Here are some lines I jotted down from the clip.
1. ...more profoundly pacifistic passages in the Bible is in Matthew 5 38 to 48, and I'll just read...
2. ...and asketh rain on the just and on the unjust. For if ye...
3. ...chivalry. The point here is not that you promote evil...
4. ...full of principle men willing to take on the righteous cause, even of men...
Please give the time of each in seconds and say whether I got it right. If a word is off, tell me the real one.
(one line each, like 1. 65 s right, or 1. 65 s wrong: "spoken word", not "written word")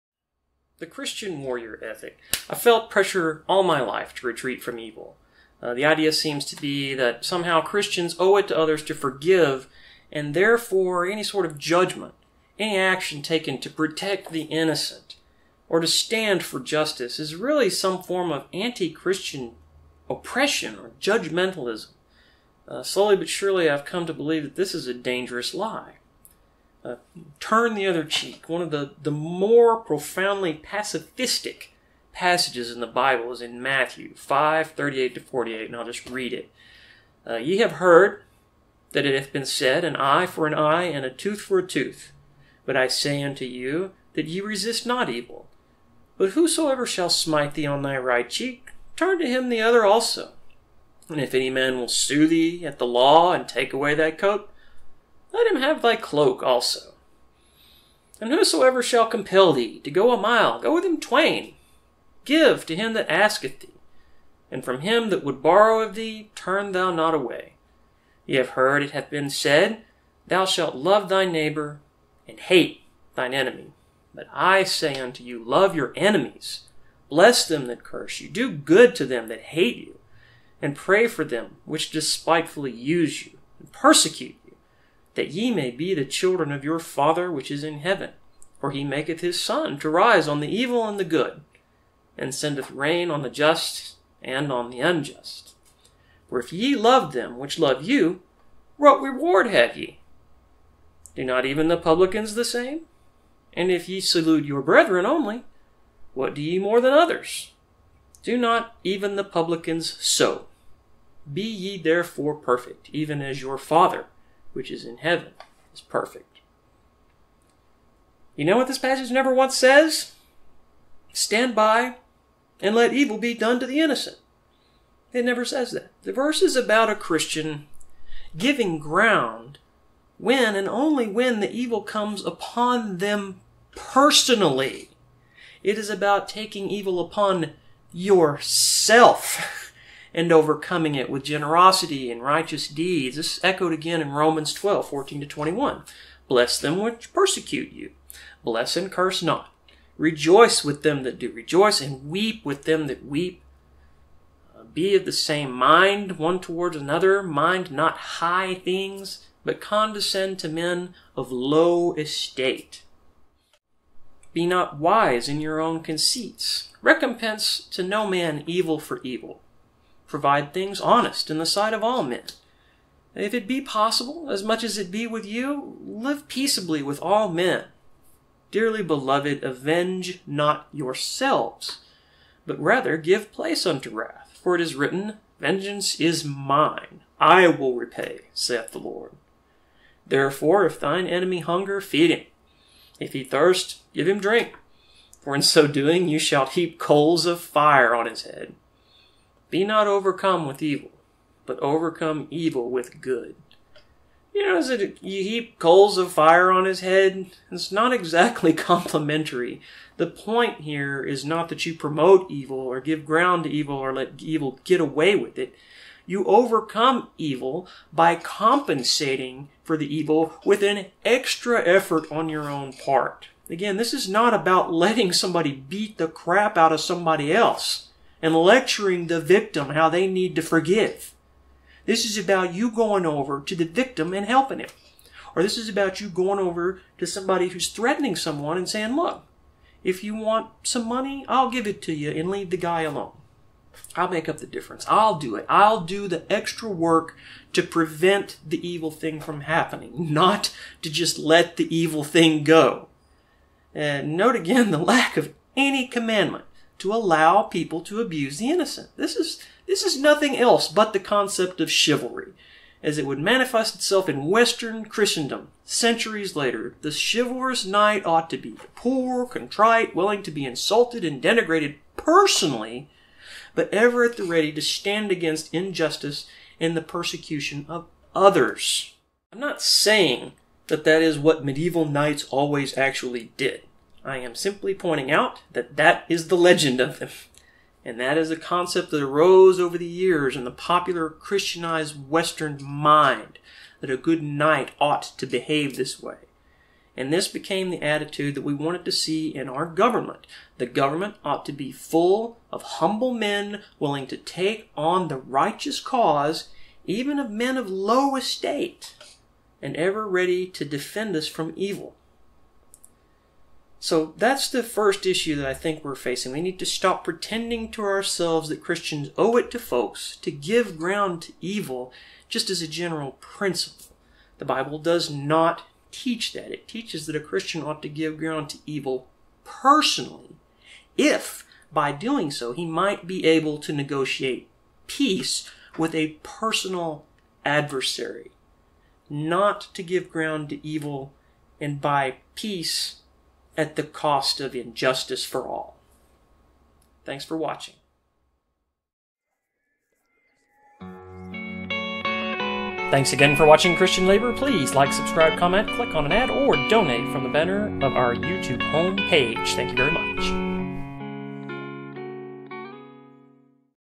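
1. 29 s right
2. 92 s wrong: "sendeth", not "asketh"
3. 208 s wrong: "complimentary", not "chivalry"
4. 301 s wrong: "humble", not "principle".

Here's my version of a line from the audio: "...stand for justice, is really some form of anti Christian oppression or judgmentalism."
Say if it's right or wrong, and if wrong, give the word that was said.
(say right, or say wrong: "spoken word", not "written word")
right.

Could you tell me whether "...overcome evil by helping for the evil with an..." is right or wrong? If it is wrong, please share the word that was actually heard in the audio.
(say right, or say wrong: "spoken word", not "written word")
wrong: "compensating", not "helping".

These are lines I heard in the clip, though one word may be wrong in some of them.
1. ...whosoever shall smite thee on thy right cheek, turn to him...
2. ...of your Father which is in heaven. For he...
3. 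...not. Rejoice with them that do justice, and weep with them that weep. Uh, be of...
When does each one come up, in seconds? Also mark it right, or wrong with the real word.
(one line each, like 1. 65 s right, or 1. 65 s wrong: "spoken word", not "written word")
1. 46 s right
2. 86 s right
3. 149 s wrong: "rejoice", not "justice".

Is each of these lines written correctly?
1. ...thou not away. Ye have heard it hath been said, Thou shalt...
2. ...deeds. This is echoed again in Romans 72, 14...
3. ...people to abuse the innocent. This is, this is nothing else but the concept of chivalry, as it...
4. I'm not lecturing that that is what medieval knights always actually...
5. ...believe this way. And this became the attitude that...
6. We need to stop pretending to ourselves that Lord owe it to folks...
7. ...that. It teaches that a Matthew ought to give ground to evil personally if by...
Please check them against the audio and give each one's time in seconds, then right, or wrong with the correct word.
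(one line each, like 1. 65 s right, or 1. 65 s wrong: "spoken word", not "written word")
1. 66 s right
2. 142 s wrong: "12", not "72"
3. 257 s right
4. 279 s wrong: "saying", not "lecturing"
5. 295 s wrong: "behave", not "believe"
6. 316 s wrong: "Christians", not "Lord"
7. 326 s wrong: "Christian", not "Matthew".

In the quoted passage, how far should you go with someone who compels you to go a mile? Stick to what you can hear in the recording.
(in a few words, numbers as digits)
twain.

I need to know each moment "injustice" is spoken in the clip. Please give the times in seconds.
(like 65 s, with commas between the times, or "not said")
275 s, 344 s.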